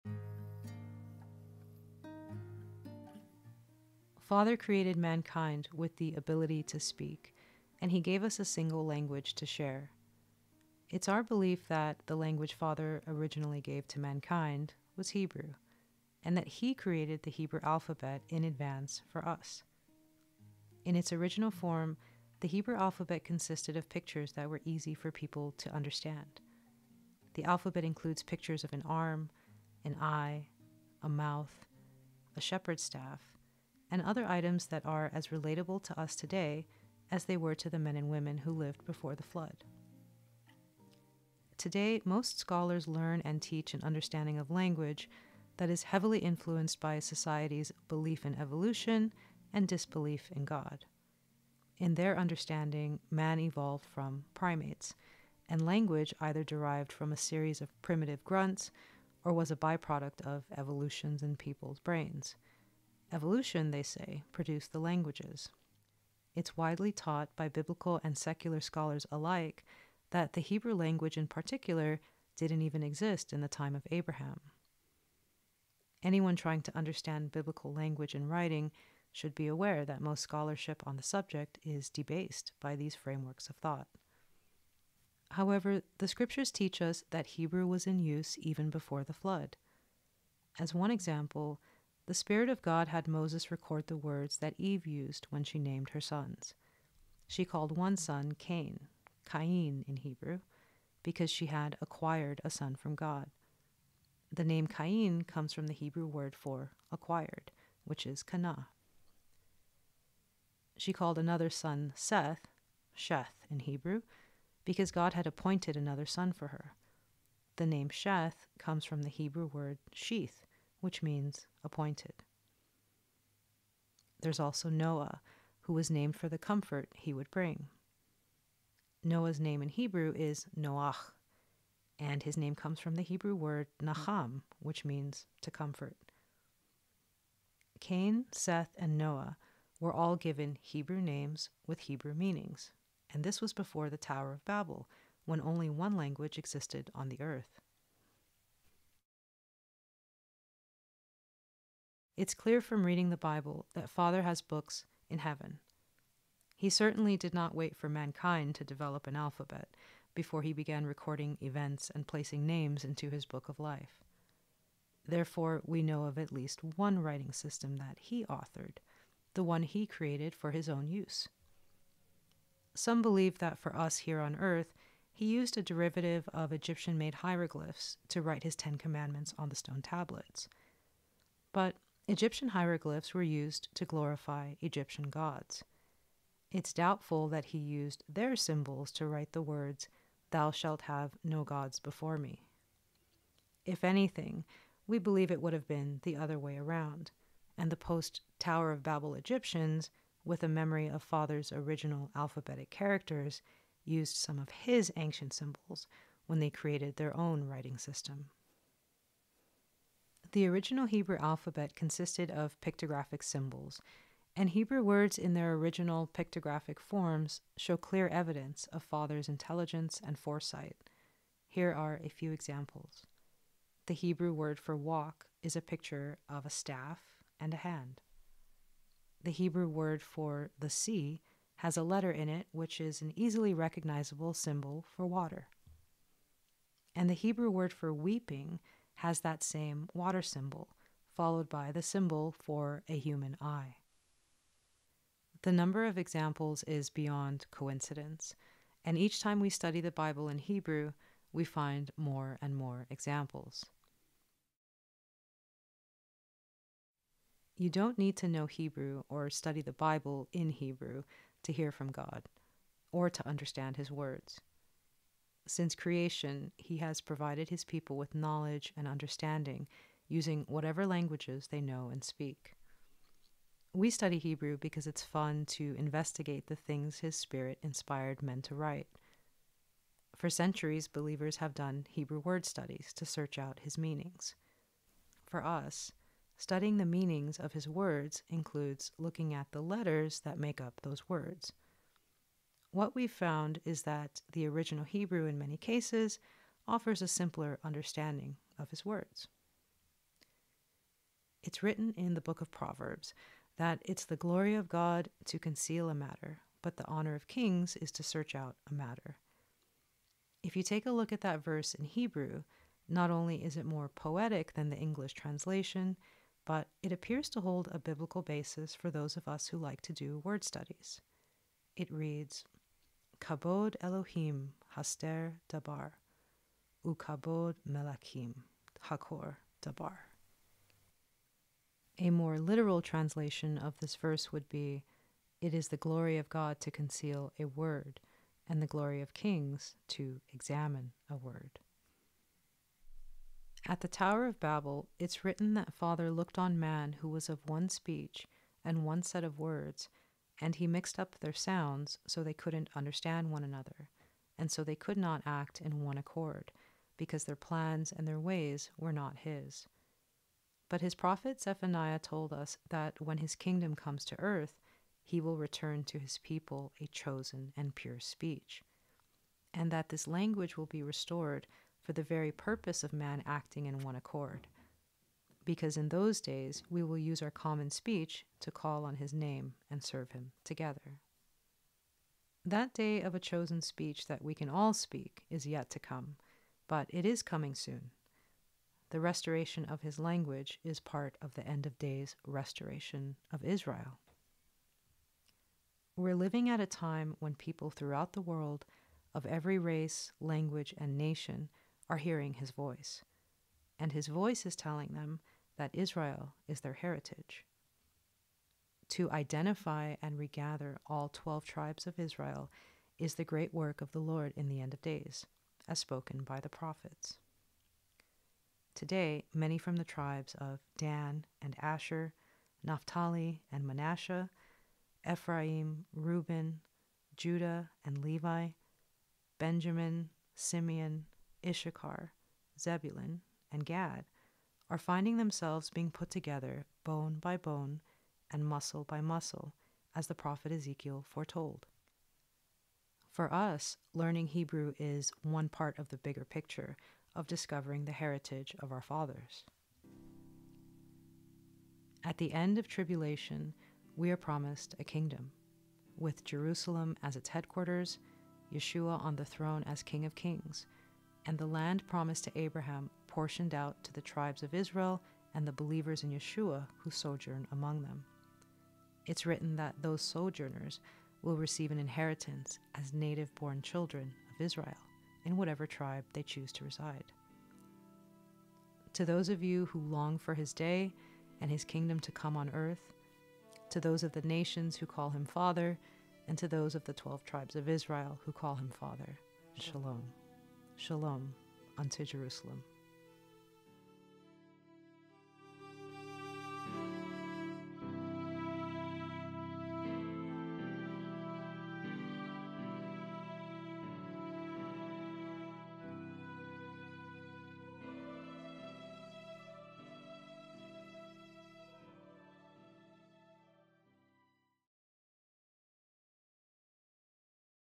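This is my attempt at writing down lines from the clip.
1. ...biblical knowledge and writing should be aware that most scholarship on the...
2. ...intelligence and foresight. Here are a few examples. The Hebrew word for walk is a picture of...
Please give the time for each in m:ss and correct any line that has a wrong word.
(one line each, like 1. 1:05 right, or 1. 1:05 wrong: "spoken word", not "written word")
1. 1:17 wrong: "language", not "knowledge"
2. 3:39 right.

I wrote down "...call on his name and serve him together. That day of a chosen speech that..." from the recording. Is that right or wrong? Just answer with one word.
right.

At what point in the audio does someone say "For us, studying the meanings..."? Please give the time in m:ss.
4:45.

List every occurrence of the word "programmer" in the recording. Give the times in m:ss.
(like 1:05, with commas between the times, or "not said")
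not said.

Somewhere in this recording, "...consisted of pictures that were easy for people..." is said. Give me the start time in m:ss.
0:23.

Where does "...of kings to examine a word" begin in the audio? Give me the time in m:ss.
5:39.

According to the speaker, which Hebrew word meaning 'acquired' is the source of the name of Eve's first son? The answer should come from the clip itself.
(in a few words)
kana.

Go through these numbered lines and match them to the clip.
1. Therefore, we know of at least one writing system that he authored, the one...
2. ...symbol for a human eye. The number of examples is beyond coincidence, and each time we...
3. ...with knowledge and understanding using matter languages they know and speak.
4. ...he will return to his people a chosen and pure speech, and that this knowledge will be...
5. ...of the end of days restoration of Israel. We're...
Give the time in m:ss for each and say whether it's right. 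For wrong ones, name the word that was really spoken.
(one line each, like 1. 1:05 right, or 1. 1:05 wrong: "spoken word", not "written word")
1. 2:45 right
2. 4:01 right
3. 4:27 wrong: "whatever", not "matter"
4. 6:05 wrong: "language", not "knowledge"
5. 6:31 right.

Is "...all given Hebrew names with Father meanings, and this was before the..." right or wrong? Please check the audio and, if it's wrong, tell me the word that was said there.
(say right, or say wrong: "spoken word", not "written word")
wrong: "Hebrew", not "Father".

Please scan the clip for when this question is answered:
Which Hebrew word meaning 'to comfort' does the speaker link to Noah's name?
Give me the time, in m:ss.
2:13.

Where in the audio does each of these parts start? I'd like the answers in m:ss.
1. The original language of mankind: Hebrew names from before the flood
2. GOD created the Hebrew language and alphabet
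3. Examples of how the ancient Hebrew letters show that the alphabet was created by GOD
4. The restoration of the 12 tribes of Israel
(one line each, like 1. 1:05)
1. 1:25
2. 2:30
3. 3:30
4. 6:28.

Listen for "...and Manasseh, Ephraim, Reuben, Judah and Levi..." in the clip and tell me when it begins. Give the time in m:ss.
7:03.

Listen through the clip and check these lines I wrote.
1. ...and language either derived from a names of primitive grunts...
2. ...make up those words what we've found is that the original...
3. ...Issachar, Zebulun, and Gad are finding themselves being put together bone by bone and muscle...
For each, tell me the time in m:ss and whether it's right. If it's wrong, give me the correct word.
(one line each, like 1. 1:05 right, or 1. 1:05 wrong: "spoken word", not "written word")
1. 0:55 wrong: "series", not "names"
2. 4:50 right
3. 7:11 right.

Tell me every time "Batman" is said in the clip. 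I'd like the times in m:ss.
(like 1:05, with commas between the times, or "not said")
not said.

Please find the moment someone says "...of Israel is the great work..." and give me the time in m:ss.
6:51.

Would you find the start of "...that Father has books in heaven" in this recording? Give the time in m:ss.
2:33.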